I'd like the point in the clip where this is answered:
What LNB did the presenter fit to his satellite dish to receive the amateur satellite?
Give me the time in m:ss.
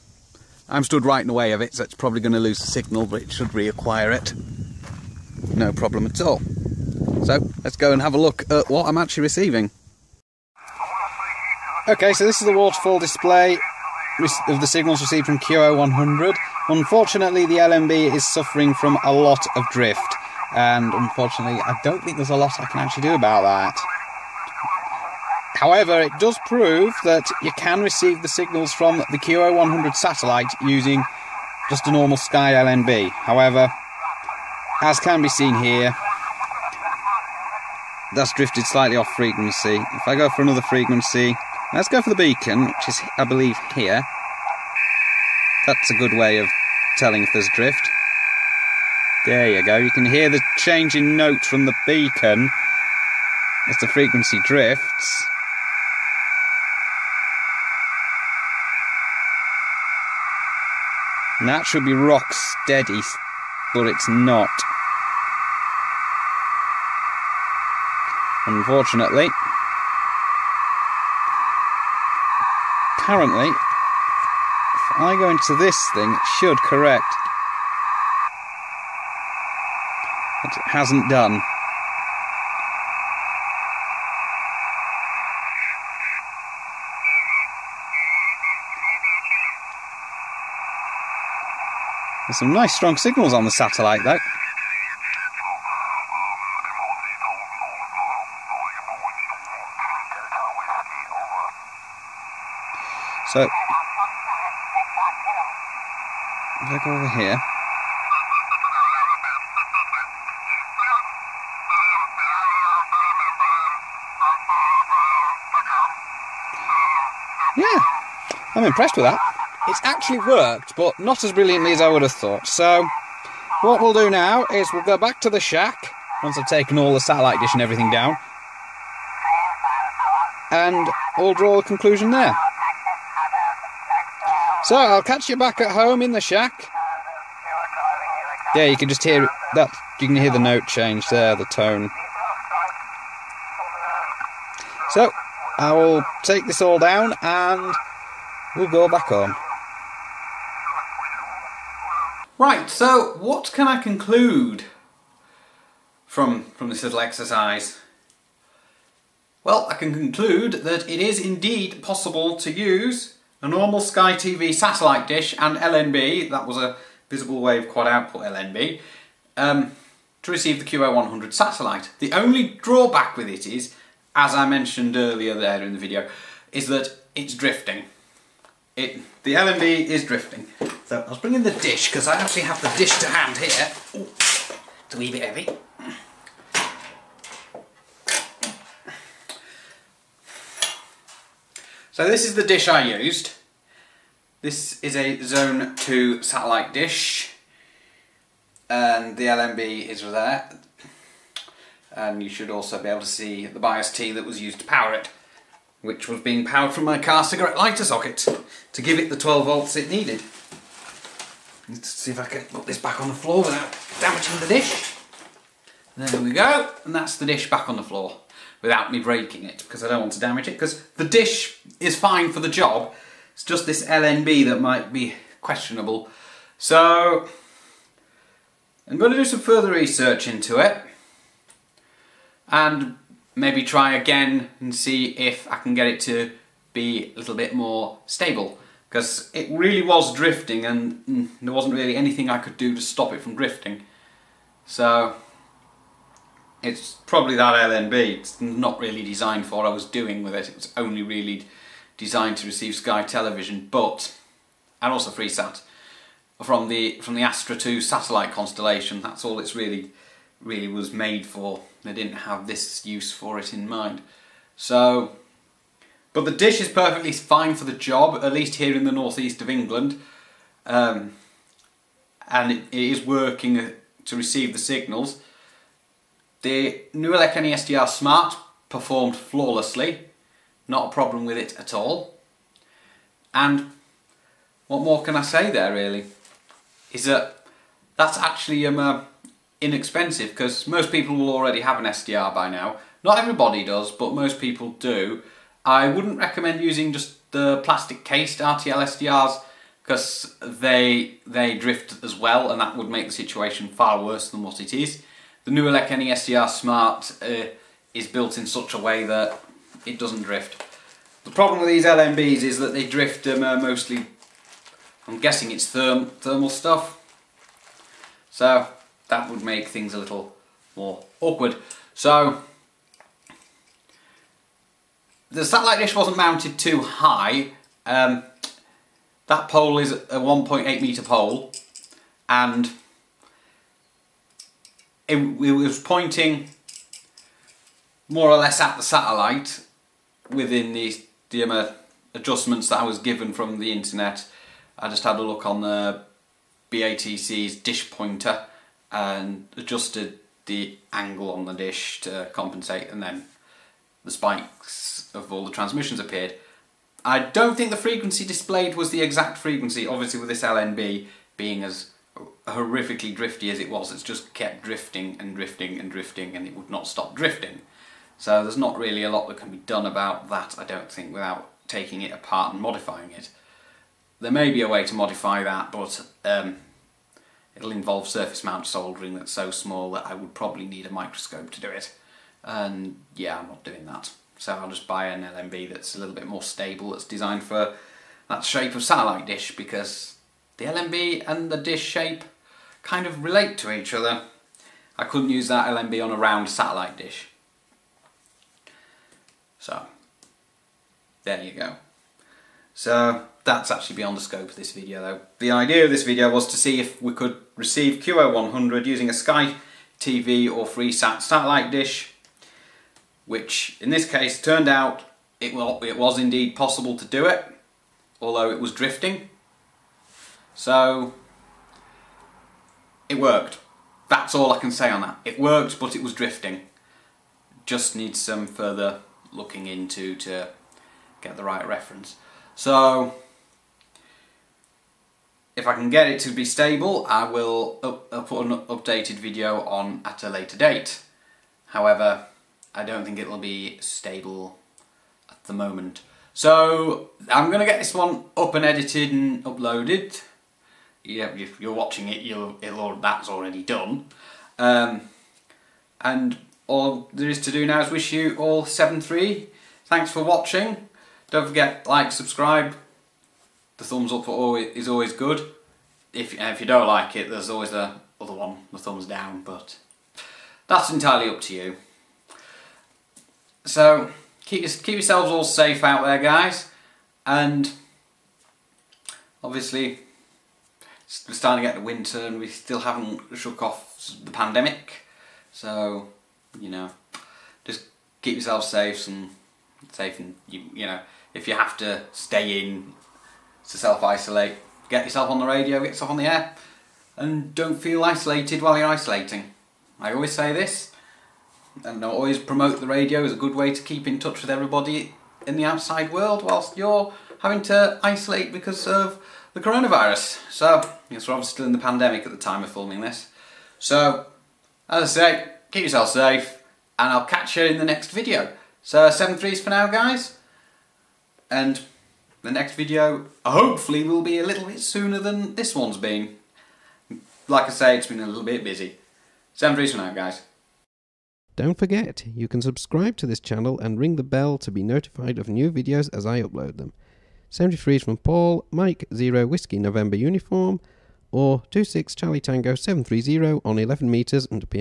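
2:47.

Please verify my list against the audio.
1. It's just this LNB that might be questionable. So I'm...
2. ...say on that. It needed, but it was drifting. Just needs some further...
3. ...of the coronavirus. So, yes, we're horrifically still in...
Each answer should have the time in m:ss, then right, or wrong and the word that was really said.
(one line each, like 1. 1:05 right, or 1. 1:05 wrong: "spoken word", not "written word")
1. 3:43 right
2. 7:04 wrong: "worked", not "needed"
3. 8:28 wrong: "obviously", not "horrifically".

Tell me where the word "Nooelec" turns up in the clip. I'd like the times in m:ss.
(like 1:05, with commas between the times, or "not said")
4:36, 5:05.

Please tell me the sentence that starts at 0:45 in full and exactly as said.
That's a good way of telling if there's drift.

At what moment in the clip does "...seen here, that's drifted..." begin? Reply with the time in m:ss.
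0:35.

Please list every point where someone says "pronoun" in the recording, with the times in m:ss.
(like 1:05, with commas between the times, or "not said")
not said.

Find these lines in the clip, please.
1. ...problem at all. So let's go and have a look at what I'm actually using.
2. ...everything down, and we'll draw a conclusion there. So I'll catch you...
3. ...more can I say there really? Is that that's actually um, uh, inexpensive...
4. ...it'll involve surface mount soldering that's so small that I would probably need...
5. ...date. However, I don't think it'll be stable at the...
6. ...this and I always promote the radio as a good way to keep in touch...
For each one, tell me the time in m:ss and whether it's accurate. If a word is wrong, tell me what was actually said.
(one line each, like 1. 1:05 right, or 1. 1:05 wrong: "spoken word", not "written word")
1. 0:05 wrong: "receiving", not "using"
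2. 2:07 right
3. 4:44 right
4. 6:17 right
5. 7:20 right
6. 8:20 right.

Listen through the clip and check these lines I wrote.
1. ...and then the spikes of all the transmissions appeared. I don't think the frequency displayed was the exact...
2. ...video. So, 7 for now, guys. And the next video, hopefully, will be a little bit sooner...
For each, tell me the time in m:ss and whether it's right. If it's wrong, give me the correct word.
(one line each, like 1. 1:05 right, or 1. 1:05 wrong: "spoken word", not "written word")
1. 5:52 right
2. 8:38 right.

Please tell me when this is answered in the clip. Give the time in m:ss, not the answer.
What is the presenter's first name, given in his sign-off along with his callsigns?
8:58.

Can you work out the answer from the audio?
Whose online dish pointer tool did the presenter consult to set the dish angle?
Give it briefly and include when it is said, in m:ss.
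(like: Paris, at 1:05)
BATC, at 5:46.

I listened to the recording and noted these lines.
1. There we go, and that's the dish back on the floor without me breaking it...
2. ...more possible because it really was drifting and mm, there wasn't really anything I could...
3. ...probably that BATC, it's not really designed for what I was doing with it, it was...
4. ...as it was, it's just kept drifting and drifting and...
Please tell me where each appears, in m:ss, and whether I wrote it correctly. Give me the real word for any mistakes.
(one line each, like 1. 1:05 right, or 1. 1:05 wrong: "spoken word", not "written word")
1. 3:35 right
2. 3:57 wrong: "stable", not "possible"
3. 4:07 wrong: "LNB", not "BATC"
4. 6:03 right.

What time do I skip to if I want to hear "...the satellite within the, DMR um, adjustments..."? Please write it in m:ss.
5:38.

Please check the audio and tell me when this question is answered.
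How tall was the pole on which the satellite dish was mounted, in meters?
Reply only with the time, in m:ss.
5:30.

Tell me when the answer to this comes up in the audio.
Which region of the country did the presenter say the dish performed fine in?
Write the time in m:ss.
4:28.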